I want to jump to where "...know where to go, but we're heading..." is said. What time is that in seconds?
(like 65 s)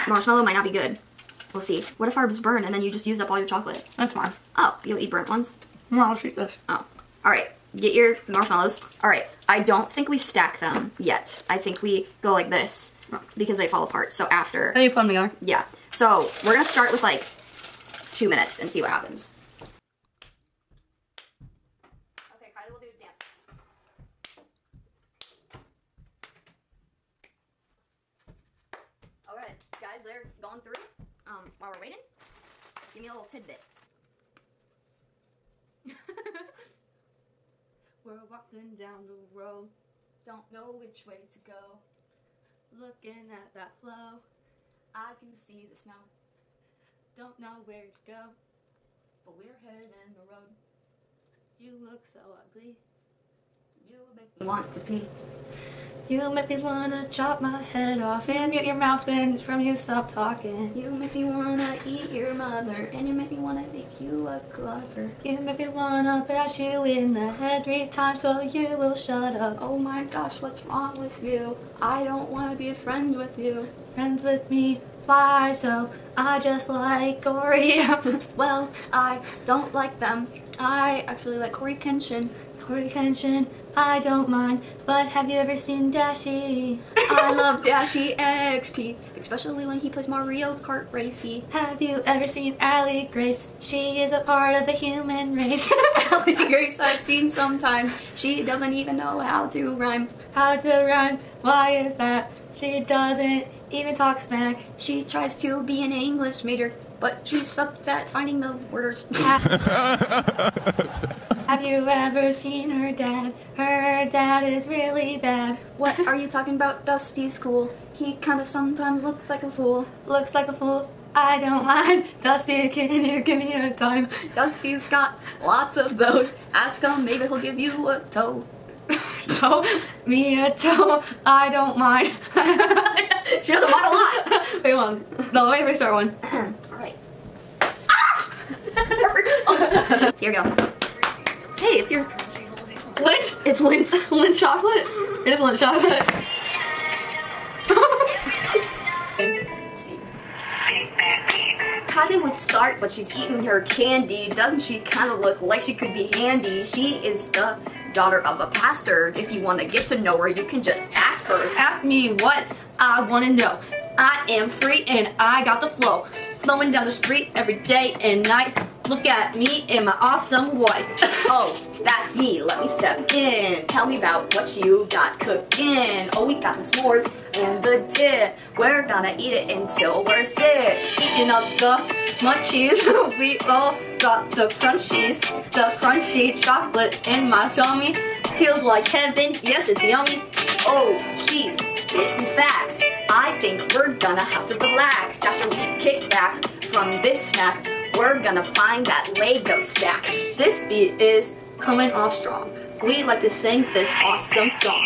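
47 s.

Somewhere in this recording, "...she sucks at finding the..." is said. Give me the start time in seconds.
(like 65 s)
107 s.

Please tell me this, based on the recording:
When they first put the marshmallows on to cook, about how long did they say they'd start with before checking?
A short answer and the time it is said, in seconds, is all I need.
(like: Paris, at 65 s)
2 minutes, at 18 s.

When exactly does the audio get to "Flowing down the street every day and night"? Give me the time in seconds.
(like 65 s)
166 s.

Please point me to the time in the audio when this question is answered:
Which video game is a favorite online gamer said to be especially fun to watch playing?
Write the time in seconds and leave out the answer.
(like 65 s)
90 s.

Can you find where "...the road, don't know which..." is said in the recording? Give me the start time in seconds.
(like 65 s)
39 s.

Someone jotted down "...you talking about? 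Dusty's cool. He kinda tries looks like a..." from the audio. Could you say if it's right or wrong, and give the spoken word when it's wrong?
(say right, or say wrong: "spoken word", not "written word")
wrong: "sometimes", not "tries".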